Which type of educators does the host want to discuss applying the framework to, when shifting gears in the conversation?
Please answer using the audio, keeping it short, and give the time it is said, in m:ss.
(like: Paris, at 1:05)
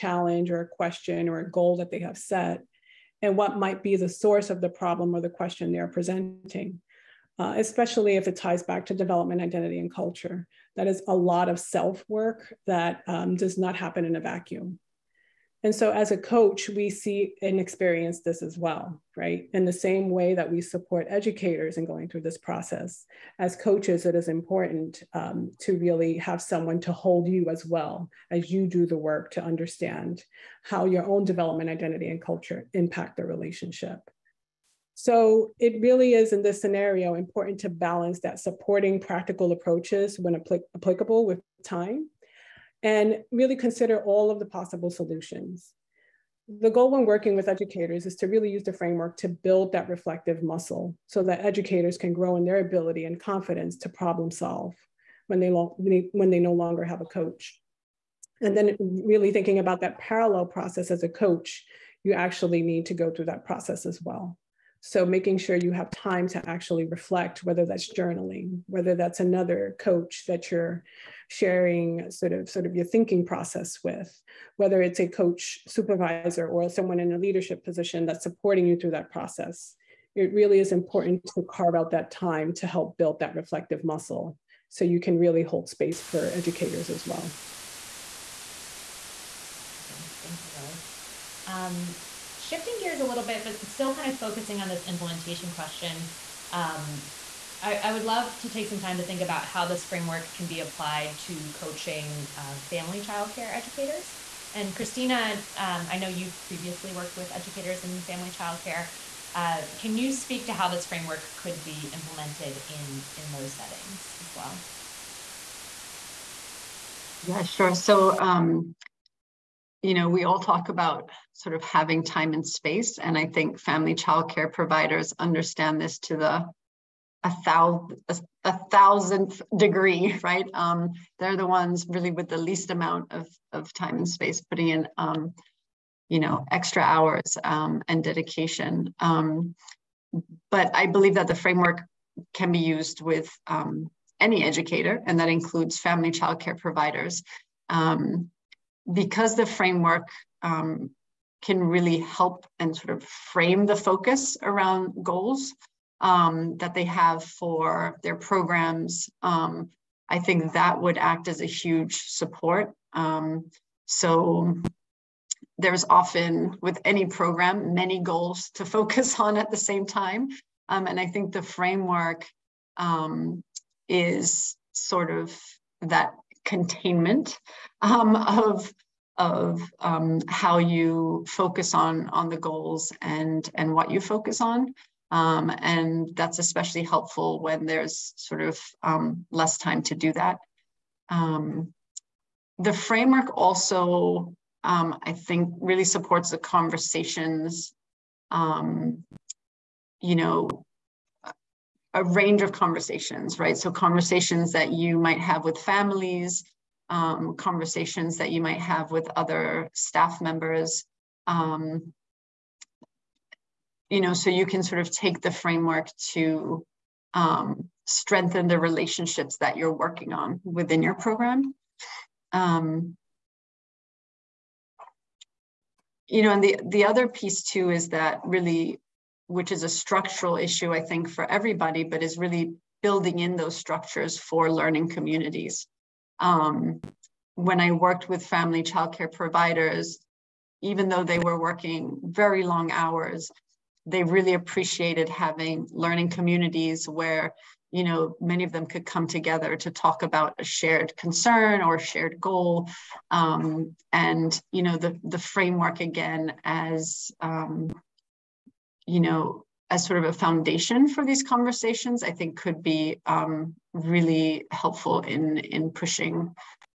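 family childcare educators, at 1:42.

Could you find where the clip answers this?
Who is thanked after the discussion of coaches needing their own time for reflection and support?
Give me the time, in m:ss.
1:30.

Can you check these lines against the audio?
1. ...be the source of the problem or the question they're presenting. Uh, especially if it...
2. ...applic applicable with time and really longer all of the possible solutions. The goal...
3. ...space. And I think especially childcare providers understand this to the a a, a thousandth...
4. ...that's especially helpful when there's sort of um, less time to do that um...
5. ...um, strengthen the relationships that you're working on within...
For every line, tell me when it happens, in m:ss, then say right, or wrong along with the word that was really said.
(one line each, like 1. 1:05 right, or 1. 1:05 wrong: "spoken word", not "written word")
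1. 0:03 right
2. 0:40 wrong: "consider", not "longer"
3. 2:02 wrong: "family", not "especially"
4. 3:06 right
5. 3:37 right.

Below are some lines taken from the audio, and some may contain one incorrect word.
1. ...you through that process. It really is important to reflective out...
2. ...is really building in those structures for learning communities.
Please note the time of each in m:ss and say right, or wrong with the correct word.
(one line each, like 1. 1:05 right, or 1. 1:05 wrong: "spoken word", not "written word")
1. 1:18 wrong: "carve", not "reflective"
2. 3:52 right.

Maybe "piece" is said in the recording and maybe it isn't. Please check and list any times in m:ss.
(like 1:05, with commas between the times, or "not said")
3:47.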